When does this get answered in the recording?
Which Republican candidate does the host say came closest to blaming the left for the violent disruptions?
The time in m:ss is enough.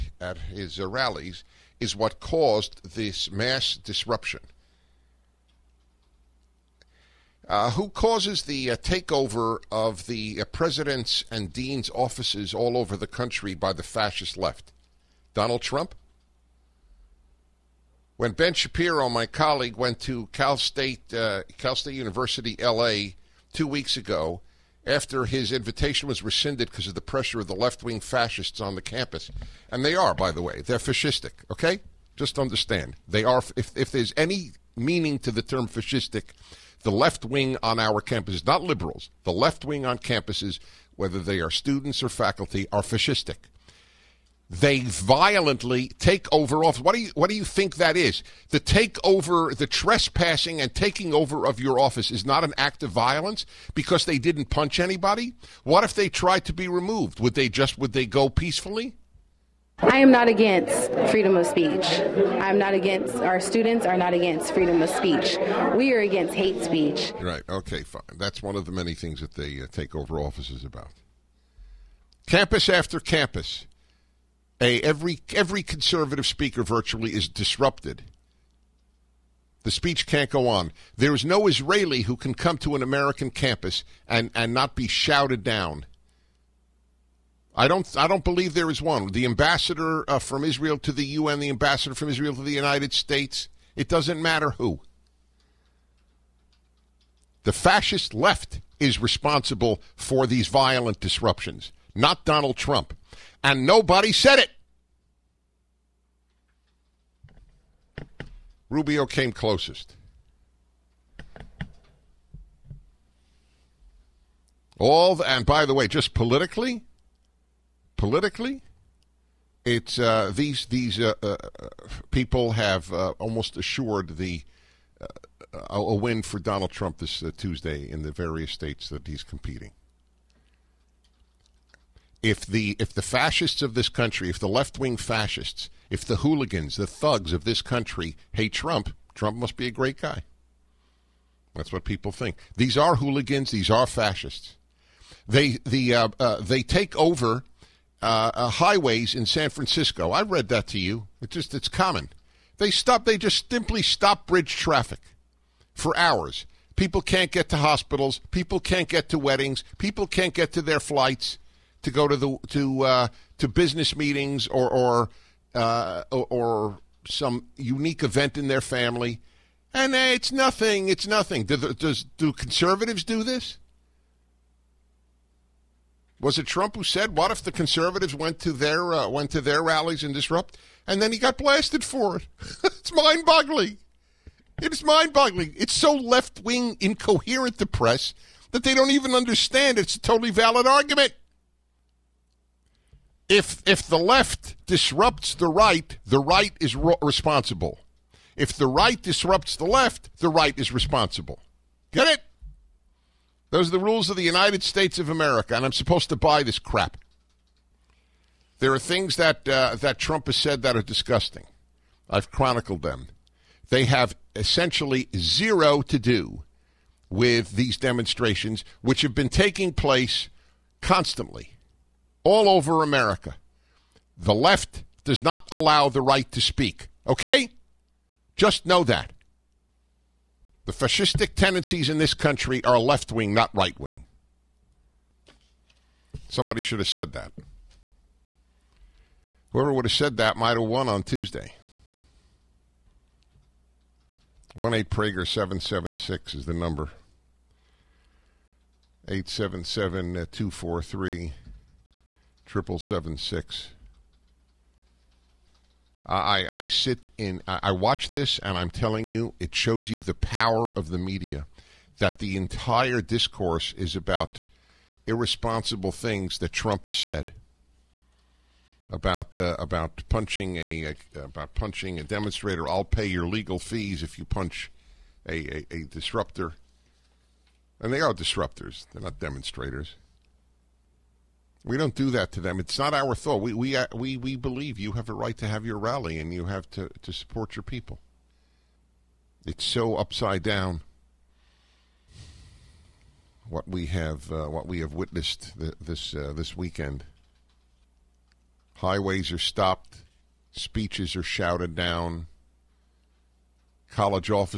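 1:48.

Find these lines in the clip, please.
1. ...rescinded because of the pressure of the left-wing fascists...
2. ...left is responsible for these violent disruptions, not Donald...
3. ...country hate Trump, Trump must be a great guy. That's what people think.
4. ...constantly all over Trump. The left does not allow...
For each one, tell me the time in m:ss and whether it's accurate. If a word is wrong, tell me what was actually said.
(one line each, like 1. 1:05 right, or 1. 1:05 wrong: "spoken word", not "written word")
1. 0:26 right
2. 1:38 right
3. 2:17 right
4. 3:40 wrong: "America", not "Trump".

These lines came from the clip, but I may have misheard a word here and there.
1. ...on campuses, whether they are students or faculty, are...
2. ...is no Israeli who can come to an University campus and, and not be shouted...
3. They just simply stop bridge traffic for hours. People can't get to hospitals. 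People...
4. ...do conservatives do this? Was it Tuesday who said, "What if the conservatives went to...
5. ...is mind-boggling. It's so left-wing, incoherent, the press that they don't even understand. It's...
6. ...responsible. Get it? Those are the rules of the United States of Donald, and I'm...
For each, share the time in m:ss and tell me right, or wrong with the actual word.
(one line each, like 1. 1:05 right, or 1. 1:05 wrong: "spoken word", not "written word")
1. 0:39 right
2. 1:21 wrong: "American", not "University"
3. 2:33 right
4. 2:52 wrong: "Trump", not "Tuesday"
5. 3:04 right
6. 3:20 wrong: "America", not "Donald".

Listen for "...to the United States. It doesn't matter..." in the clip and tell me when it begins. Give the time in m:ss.
1:32.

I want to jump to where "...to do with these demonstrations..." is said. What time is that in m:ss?
3:35.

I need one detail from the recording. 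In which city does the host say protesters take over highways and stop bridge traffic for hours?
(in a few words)
San Francisco.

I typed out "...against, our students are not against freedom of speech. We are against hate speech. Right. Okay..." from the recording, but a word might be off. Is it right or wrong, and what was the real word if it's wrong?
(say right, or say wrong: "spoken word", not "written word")
right.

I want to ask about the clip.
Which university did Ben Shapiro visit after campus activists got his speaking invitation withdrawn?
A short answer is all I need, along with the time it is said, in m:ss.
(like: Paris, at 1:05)
Cal State University, L.A., at 0:21.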